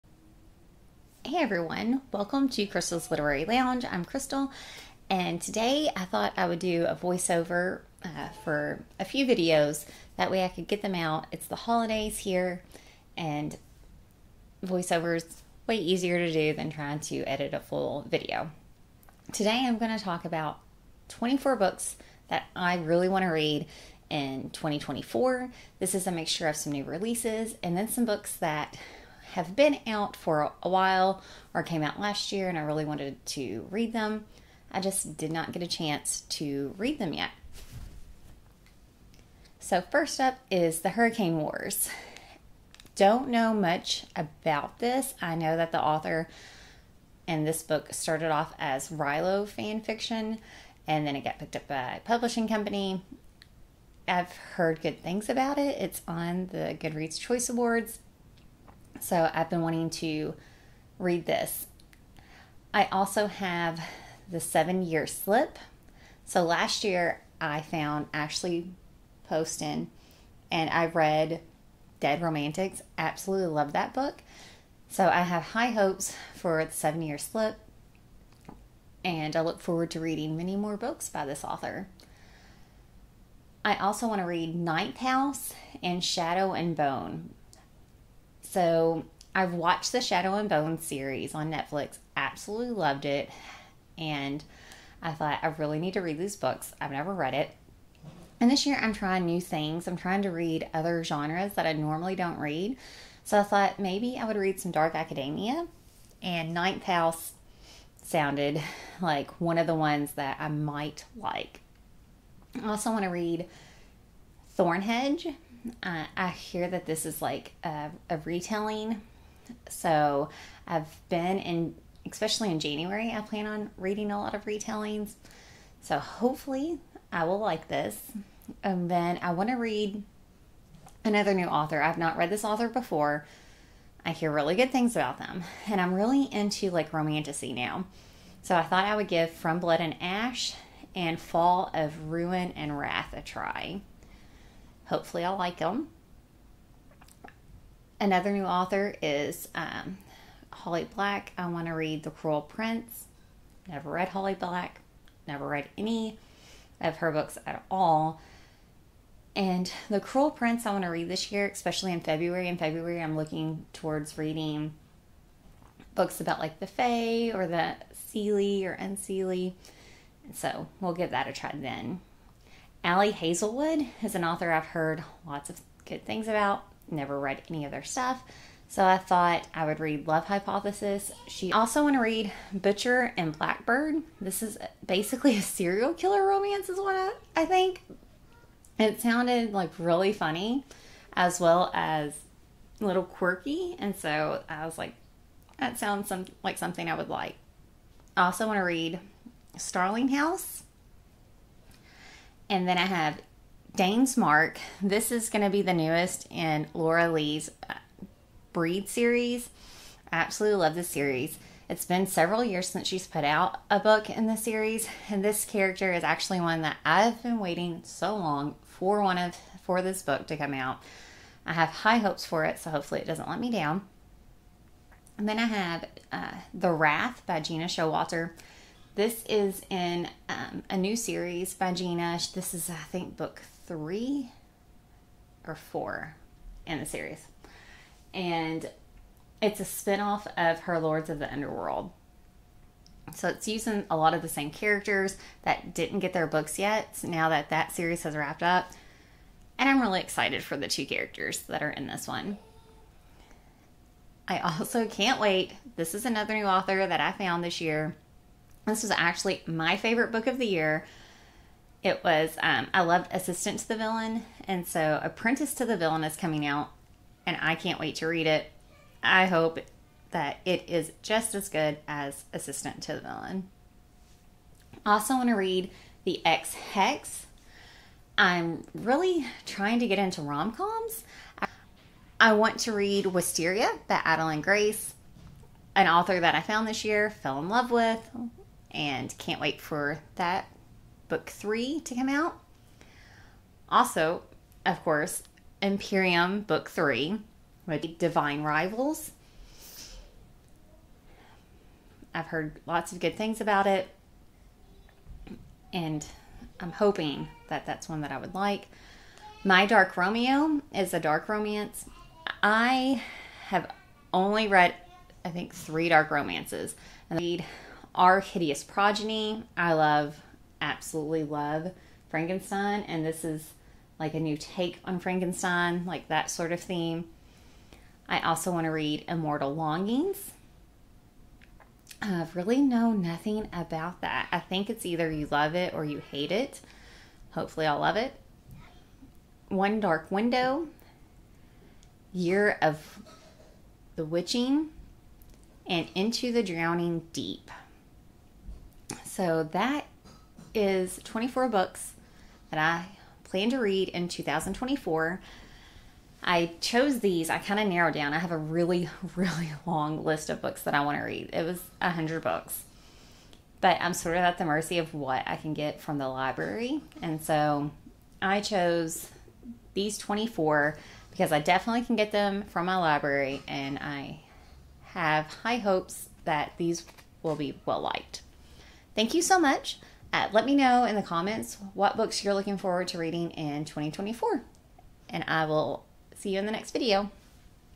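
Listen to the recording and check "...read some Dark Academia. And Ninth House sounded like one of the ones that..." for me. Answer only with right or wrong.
right.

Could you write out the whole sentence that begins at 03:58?
And it's a spinoff of her Lords of the Underworld.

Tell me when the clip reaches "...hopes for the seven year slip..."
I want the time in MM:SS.
01:15.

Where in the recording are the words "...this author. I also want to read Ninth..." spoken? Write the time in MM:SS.
01:21.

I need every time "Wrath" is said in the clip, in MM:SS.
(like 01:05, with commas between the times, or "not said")
02:22, 03:46.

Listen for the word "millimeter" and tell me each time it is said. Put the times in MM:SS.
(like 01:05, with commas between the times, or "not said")
not said.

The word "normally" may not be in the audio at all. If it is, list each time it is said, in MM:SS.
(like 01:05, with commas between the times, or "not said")
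01:41.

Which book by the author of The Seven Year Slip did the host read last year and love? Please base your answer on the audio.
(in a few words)
Dead Romantics.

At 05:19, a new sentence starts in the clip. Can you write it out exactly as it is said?
I love, absolutely love Frankenstein, and this is like a new take on Frankenstein, like that sort of theme.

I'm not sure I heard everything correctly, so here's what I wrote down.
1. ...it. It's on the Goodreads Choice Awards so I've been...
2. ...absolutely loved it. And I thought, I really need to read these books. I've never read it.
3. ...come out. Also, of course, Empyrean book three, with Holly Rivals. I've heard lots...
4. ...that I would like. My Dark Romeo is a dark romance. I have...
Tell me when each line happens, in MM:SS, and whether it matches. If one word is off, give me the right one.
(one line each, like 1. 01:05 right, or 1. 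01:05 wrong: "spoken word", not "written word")
1. 00:55 right
2. 01:32 right
3. 04:51 wrong: "Divine", not "Holly"
4. 05:08 right.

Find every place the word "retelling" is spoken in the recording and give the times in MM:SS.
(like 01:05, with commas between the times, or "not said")
01:58, 02:04.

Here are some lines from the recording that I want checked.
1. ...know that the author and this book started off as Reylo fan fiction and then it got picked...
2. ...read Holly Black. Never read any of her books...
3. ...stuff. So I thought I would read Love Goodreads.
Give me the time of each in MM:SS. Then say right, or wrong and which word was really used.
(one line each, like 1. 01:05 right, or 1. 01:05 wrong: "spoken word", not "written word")
1. 00:45 right
2. 02:33 right
3. 02:57 wrong: "Hypothesis", not "Goodreads".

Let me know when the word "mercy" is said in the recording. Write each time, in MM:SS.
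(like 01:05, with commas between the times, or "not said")
06:04.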